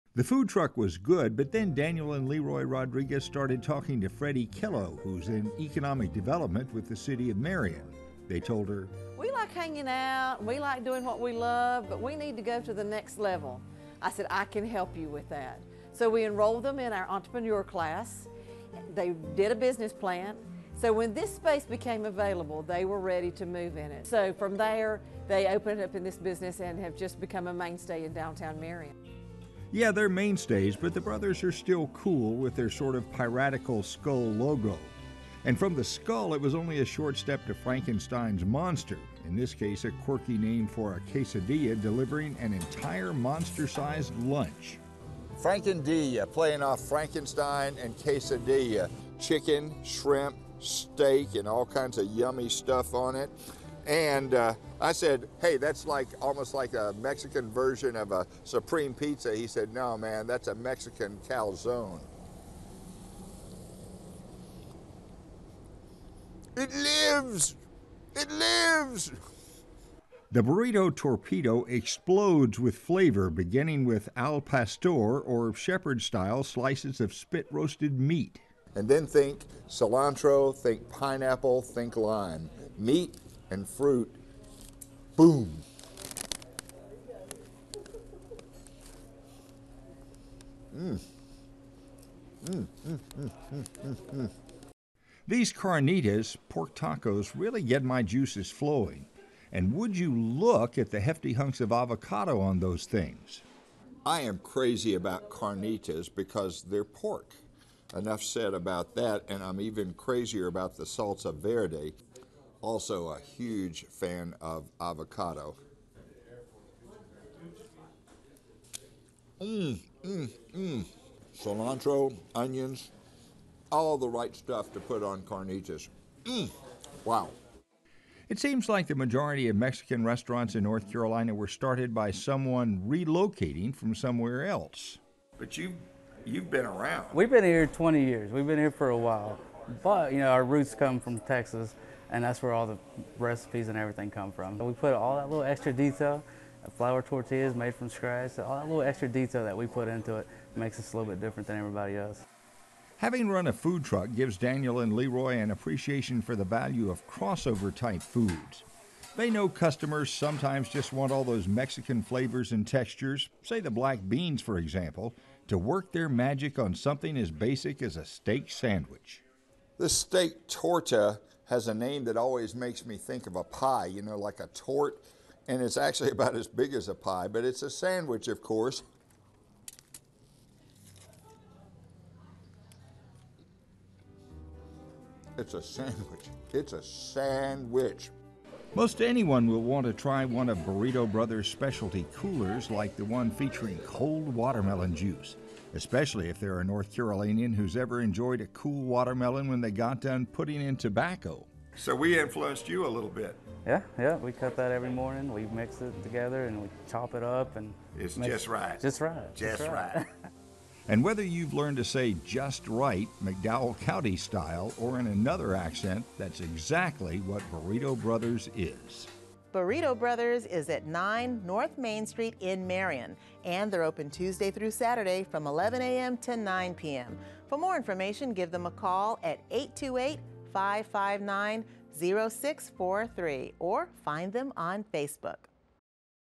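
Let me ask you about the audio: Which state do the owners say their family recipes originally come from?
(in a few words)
Texas.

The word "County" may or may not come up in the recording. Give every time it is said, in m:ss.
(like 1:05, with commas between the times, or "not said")
3:33.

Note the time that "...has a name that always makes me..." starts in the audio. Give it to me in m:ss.
2:51.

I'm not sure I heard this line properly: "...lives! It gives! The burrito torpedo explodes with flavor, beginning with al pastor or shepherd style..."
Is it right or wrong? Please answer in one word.
wrong.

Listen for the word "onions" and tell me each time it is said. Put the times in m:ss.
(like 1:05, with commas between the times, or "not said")
2:02.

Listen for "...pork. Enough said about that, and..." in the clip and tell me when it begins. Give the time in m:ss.
1:46.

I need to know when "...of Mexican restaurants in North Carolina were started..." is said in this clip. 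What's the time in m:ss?
2:09.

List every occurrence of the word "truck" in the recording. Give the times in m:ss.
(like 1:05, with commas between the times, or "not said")
0:00, 2:33.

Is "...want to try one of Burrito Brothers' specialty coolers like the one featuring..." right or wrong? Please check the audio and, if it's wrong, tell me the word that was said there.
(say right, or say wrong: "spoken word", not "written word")
right.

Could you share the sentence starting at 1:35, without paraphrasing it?
These carnitas, pork tacos, really get my juices flowing.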